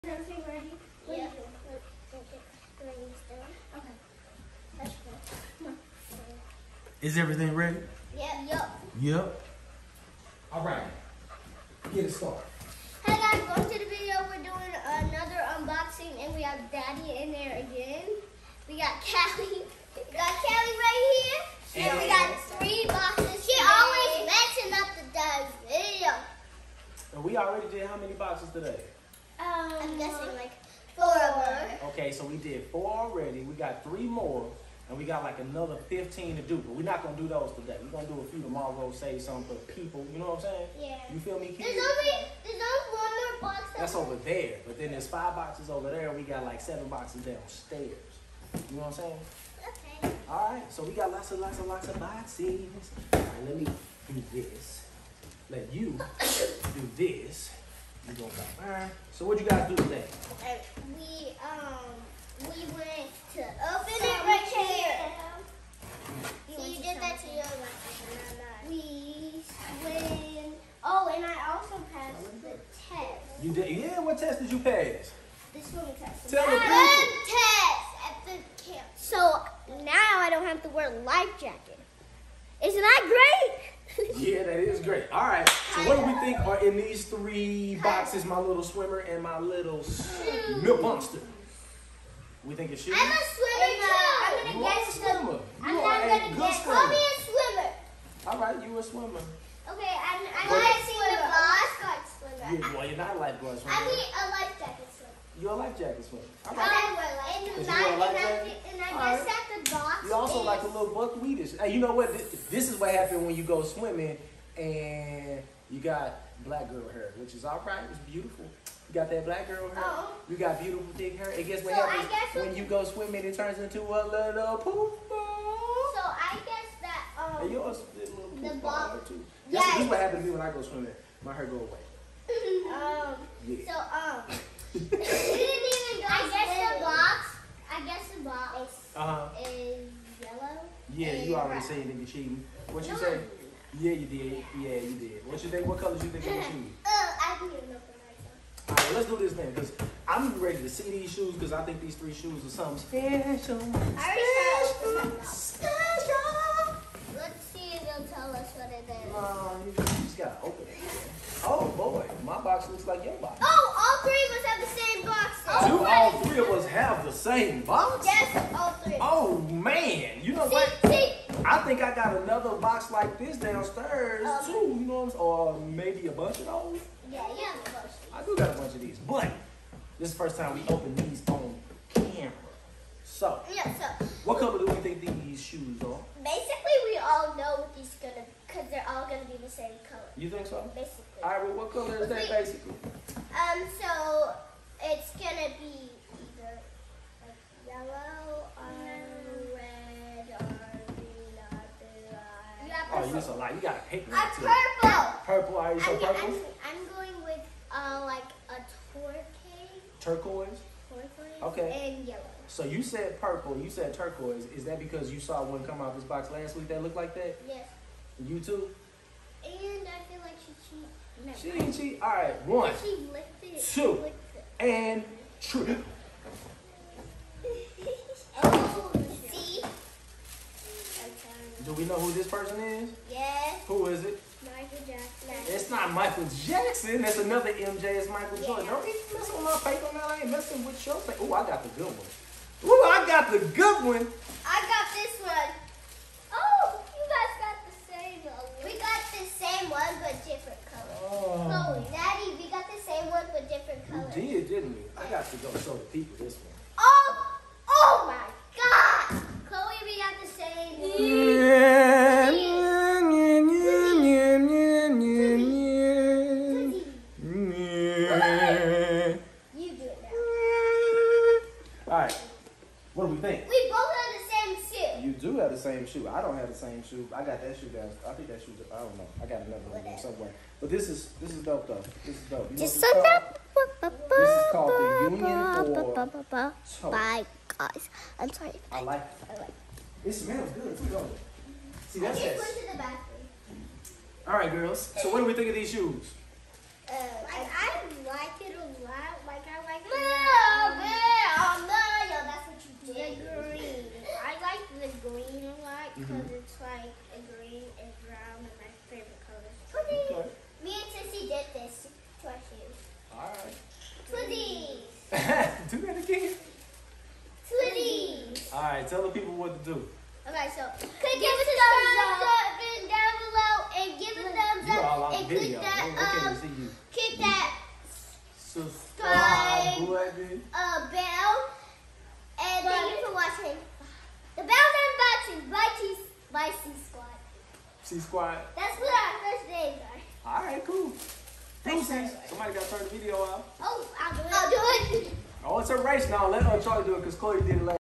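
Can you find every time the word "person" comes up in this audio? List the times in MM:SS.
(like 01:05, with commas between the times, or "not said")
03:52.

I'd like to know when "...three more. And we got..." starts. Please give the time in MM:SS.
00:33.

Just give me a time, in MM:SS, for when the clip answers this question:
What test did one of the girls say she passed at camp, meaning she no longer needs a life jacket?
01:15.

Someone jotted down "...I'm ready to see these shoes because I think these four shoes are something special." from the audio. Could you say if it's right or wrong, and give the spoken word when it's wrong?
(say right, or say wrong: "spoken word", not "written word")
wrong: "three", not "four".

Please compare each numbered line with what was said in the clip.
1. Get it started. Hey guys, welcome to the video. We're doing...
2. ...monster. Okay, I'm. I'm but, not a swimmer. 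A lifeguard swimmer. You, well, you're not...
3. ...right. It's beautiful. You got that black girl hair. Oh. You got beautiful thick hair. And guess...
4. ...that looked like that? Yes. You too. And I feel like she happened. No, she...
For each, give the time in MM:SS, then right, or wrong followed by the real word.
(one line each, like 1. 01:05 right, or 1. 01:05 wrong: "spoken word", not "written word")
1. 00:11 right
2. 01:38 wrong: "swimmer", not "monster"
3. 01:57 right
4. 03:36 wrong: "cheated", not "happened".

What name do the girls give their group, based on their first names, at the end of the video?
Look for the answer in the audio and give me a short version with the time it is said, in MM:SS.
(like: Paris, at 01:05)
C Squad, at 05:37.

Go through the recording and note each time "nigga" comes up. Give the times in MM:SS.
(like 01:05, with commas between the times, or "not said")
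02:21, 02:26.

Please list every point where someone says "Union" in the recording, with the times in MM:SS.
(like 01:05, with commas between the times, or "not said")
04:45.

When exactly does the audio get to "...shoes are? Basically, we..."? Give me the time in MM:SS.
03:05.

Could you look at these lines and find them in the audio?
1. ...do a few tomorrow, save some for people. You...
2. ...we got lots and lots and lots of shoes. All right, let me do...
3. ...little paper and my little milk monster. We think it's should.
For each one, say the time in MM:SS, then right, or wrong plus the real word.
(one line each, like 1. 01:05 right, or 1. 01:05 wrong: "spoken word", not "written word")
1. 00:38 right
2. 00:50 wrong: "boxes", not "shoes"
3. 01:28 wrong: "swimmer", not "paper".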